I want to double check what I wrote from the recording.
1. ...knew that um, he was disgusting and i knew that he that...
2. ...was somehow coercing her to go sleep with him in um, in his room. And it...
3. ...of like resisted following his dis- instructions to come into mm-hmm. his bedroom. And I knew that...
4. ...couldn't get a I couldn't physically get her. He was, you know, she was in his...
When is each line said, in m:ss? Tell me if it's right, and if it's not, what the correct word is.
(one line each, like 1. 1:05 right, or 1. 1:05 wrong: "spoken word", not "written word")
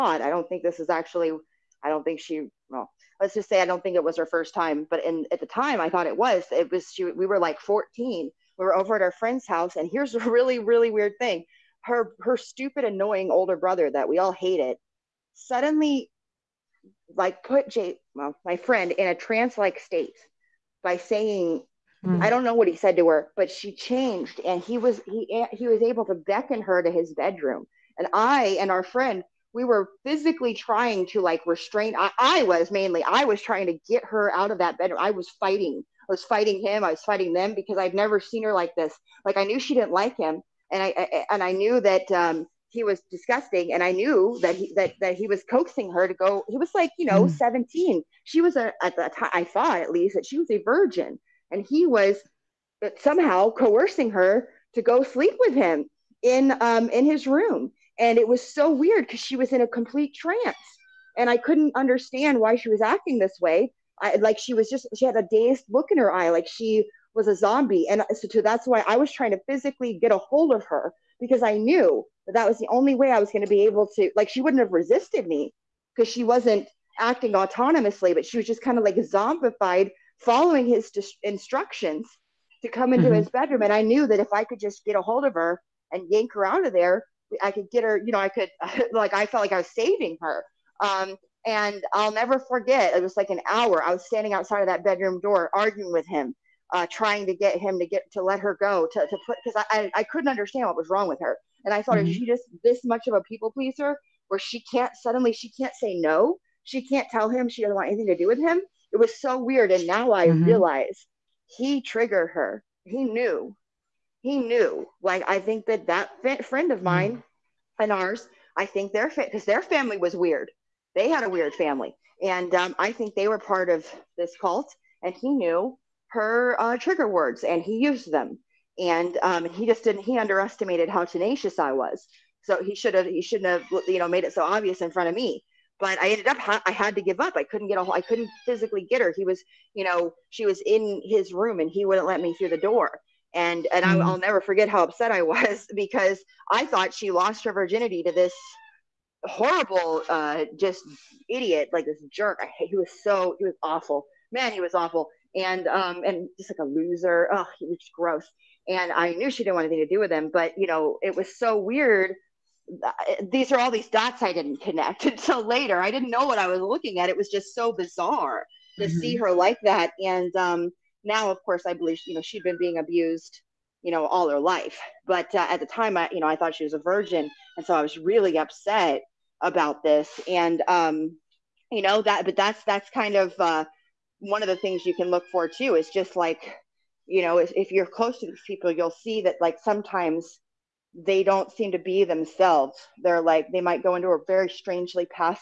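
1. 0:41 right
2. 0:51 right
3. 1:18 wrong: "zombified", not "resisted"
4. 2:17 right.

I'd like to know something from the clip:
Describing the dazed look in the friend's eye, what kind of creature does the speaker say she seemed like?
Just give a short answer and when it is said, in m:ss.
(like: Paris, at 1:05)
a zombie, at 1:07.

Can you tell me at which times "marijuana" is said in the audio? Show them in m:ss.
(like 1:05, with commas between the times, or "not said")
not said.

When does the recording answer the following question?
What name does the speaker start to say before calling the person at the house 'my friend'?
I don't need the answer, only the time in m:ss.
0:17.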